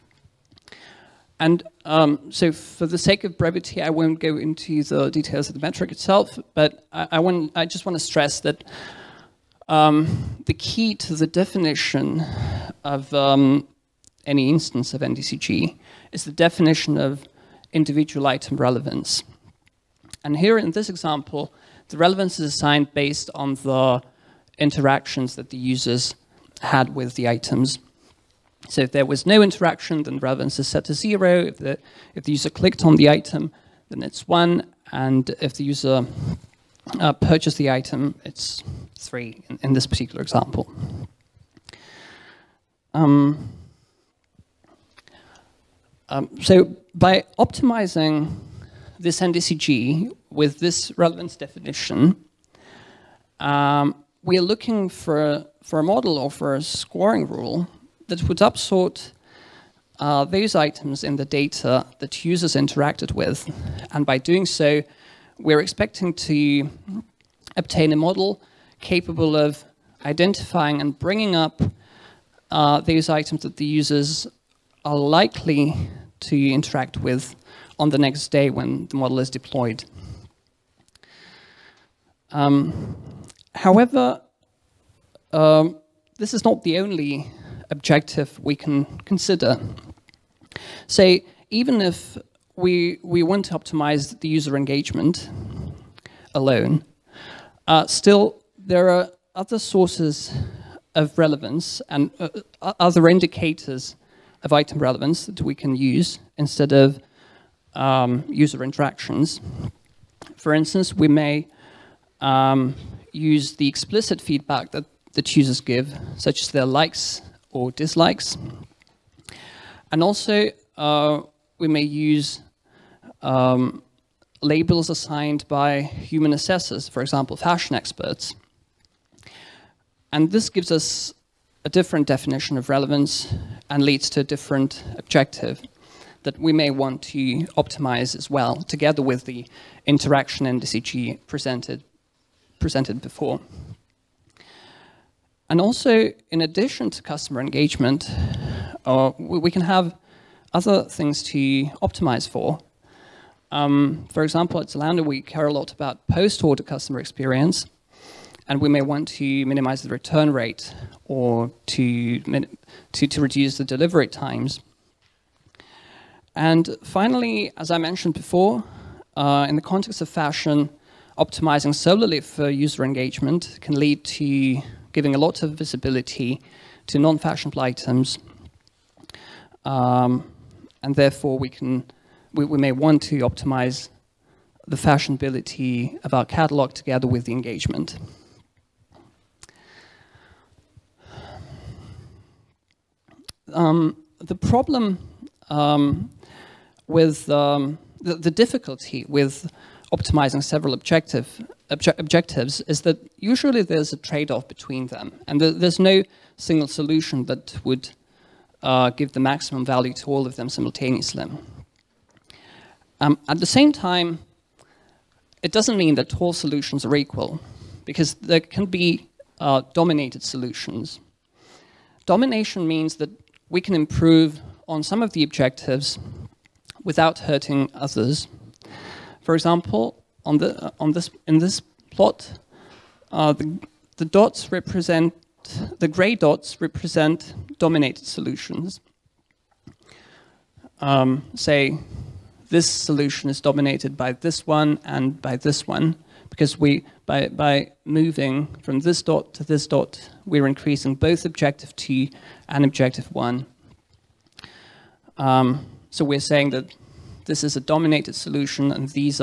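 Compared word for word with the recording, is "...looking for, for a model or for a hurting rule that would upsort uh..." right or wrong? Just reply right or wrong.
wrong.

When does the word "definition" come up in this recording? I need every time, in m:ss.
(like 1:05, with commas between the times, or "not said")
0:11, 0:16, 0:51, 2:12.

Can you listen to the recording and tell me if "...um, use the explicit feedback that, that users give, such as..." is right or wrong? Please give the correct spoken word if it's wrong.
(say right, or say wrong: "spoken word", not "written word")
right.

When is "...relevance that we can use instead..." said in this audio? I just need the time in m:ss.
1:44.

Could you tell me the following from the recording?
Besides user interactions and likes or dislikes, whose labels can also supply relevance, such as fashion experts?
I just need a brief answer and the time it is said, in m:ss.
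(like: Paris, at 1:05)
human assessors, at 2:05.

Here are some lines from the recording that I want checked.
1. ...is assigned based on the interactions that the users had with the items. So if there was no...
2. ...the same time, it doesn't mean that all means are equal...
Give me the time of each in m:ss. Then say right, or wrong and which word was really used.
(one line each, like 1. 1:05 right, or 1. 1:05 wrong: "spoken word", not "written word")
1. 0:22 right
2. 3:33 wrong: "solutions", not "means".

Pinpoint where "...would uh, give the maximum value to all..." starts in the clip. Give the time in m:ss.
3:27.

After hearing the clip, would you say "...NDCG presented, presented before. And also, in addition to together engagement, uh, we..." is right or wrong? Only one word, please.
wrong.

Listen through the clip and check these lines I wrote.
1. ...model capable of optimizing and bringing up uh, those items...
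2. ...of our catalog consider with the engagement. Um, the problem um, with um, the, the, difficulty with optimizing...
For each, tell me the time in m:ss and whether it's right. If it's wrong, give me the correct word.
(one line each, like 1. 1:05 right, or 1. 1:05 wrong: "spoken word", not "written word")
1. 1:07 wrong: "identifying", not "optimizing"
2. 3:06 wrong: "together", not "consider".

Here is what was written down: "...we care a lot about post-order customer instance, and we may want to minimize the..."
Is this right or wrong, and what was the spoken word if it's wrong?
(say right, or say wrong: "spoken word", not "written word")
wrong: "experience", not "instance".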